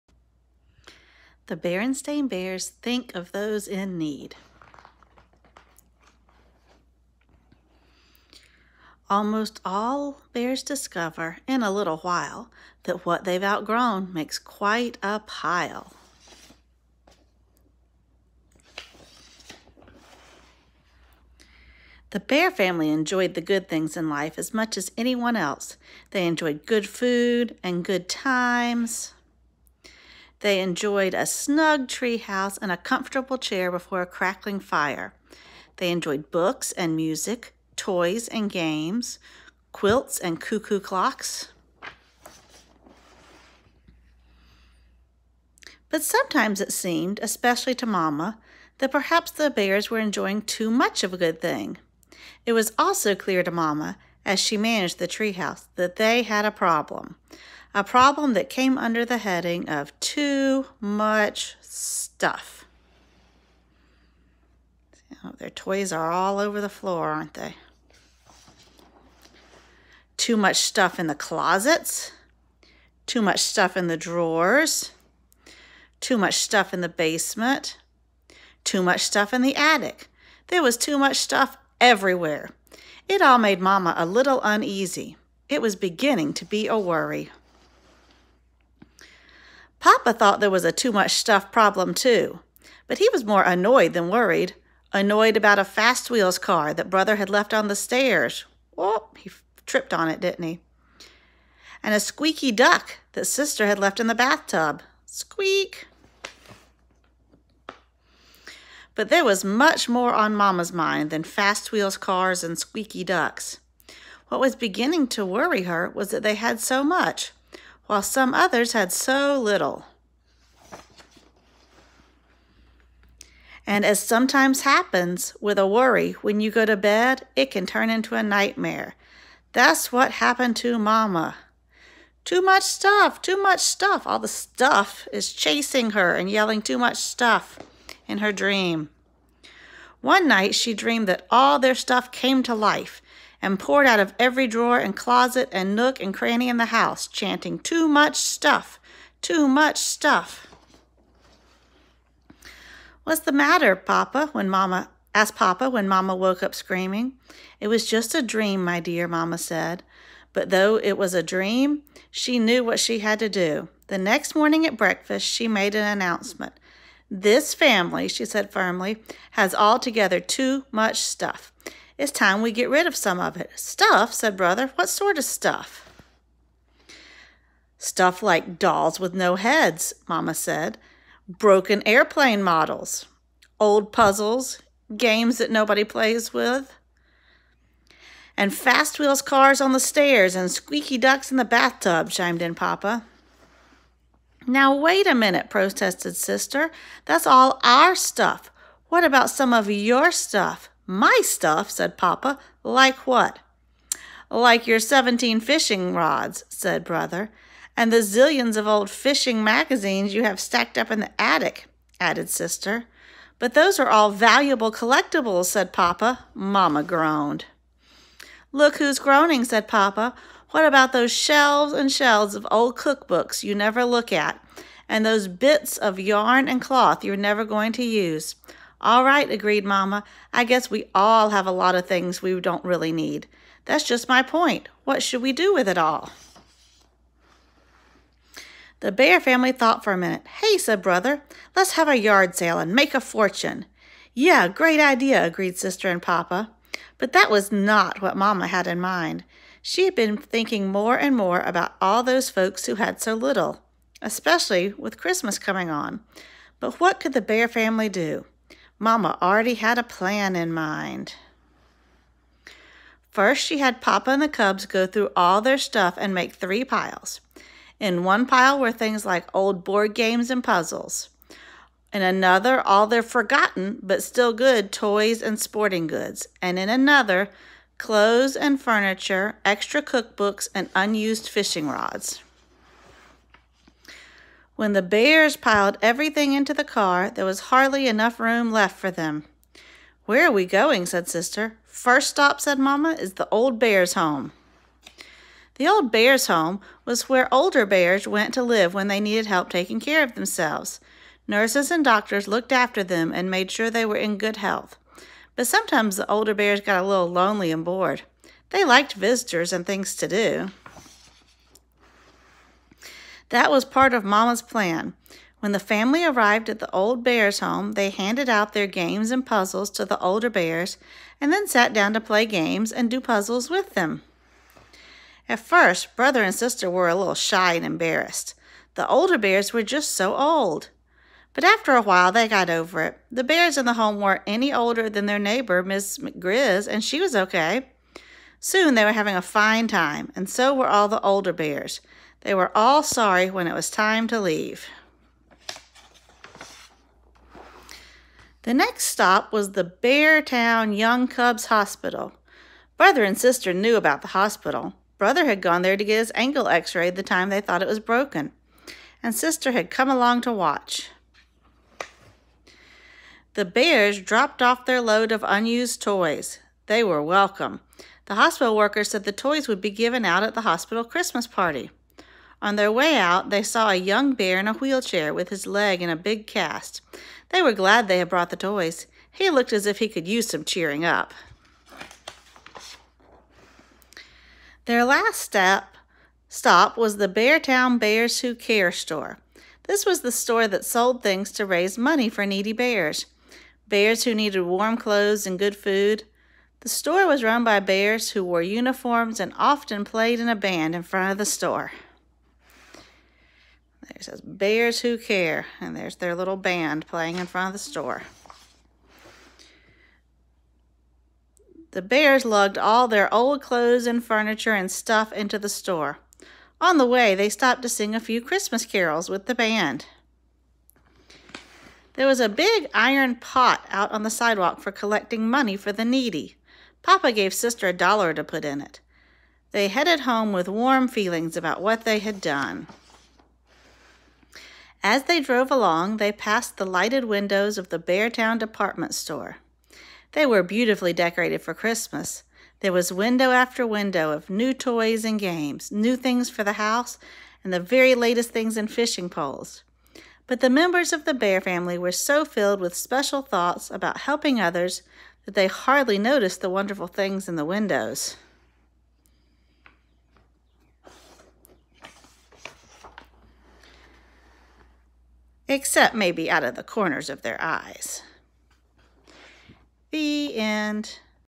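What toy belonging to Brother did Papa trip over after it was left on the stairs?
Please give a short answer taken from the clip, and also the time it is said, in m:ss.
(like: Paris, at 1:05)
fast wheels car, at 1:35.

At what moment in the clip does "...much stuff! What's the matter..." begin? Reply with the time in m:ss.
2:29.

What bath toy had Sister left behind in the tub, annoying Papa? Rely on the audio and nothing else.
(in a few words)
squeaky duck.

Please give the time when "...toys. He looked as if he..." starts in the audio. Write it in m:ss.
6:18.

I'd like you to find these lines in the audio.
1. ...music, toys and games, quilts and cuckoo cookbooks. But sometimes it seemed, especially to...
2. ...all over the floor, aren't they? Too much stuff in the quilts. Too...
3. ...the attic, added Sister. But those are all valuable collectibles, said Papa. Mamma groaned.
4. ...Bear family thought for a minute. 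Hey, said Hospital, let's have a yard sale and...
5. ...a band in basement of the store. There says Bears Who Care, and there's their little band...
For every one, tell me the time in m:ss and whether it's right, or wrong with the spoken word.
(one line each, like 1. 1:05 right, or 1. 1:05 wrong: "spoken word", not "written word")
1. 0:36 wrong: "clocks", not "cookbooks"
2. 1:06 wrong: "closets", not "quilts"
3. 3:31 right
4. 3:58 wrong: "Brother", not "Hospital"
5. 6:40 wrong: "front", not "basement".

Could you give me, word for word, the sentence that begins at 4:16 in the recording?
But what could the Bear family do?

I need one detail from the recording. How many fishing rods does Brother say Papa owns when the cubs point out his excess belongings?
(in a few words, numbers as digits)
17.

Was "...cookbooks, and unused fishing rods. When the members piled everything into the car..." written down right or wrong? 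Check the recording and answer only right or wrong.
wrong.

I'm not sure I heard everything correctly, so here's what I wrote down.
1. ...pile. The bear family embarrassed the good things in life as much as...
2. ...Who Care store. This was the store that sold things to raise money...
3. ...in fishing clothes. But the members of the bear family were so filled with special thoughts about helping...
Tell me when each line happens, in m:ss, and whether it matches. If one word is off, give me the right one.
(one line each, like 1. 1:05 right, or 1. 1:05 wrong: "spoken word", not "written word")
1. 0:15 wrong: "enjoyed", not "embarrassed"
2. 6:28 right
3. 7:28 wrong: "poles", not "clothes".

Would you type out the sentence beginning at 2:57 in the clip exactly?
Stuff like dolls with no heads, Mamma said.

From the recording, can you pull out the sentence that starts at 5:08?
They liked visitors and things to do.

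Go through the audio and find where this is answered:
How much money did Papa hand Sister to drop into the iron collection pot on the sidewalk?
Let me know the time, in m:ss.
7:07.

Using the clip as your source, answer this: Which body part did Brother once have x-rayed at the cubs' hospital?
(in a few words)
his ankle.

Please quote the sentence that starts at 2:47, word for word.
This family, she said firmly, has altogether too much stuff.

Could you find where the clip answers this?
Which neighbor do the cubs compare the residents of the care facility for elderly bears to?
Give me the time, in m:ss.
5:35.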